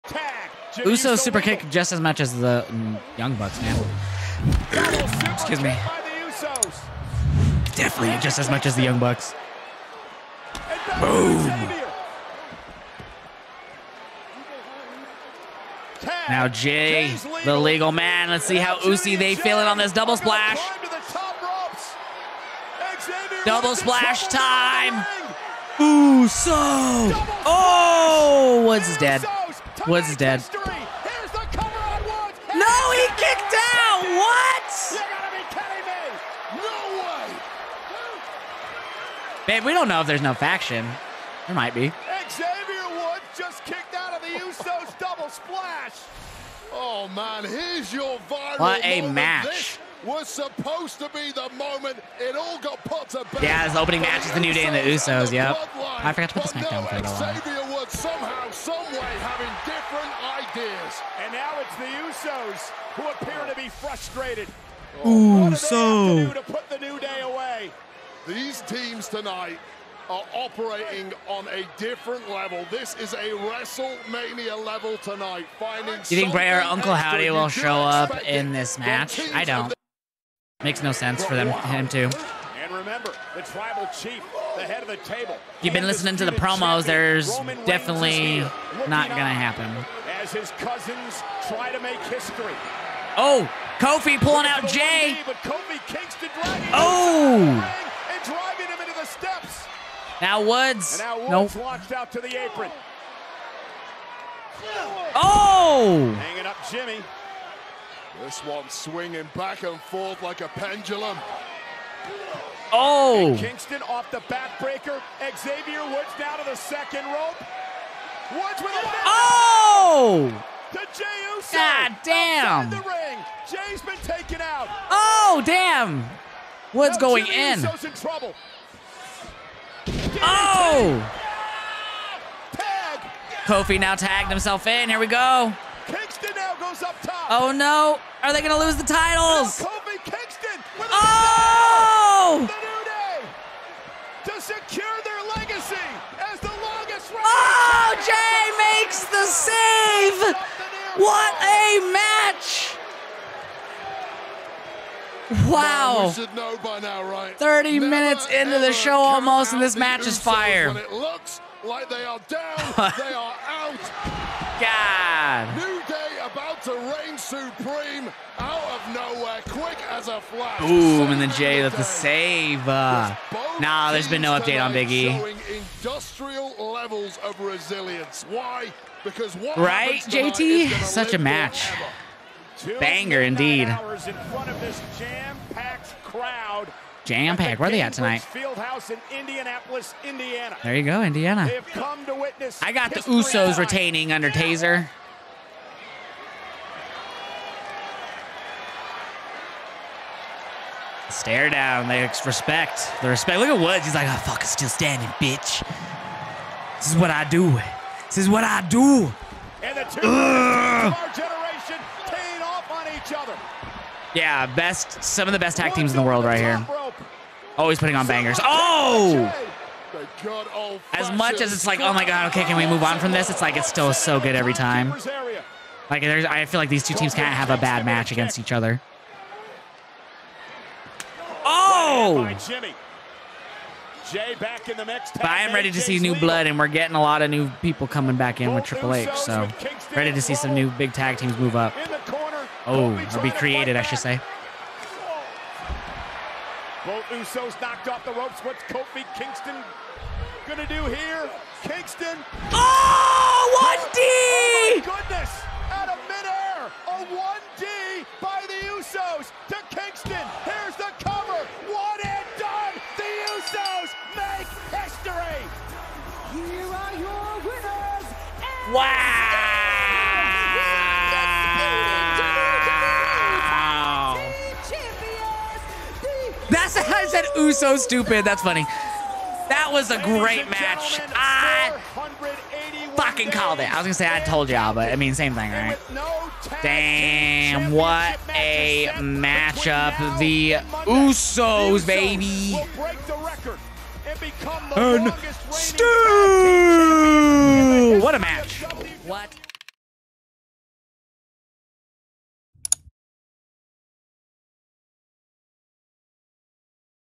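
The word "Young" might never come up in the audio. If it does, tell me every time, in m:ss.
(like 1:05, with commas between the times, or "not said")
0:03, 0:08.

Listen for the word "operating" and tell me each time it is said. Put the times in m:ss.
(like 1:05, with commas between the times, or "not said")
1:10.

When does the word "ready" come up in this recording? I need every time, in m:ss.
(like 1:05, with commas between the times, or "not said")
3:55, 3:59.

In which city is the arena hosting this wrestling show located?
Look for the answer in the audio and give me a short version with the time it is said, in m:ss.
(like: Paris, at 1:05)
Indianapolis, at 3:09.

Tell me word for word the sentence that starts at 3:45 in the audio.
Like, I feel like these two teams can't have a bad match against each other.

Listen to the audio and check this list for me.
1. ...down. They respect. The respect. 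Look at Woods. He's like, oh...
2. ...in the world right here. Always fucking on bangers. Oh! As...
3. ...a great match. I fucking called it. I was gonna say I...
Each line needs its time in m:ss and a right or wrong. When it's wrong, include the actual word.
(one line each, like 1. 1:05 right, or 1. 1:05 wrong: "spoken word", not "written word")
1. 3:21 right
2. 3:35 wrong: "putting", not "fucking"
3. 4:39 right.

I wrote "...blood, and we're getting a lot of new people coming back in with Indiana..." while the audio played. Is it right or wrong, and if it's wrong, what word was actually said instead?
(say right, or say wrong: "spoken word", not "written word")
wrong: "Triple", not "Indiana".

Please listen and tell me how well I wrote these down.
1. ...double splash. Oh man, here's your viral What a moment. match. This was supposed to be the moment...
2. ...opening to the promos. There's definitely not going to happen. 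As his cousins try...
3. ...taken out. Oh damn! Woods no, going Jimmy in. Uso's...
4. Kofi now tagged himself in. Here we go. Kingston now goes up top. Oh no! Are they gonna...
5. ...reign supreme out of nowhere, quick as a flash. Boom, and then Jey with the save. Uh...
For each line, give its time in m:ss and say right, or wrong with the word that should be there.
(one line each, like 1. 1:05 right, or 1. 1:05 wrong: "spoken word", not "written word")
1. 0:44 right
2. 1:25 wrong: "listening", not "opening"
3. 2:04 right
4. 2:13 right
5. 2:46 right.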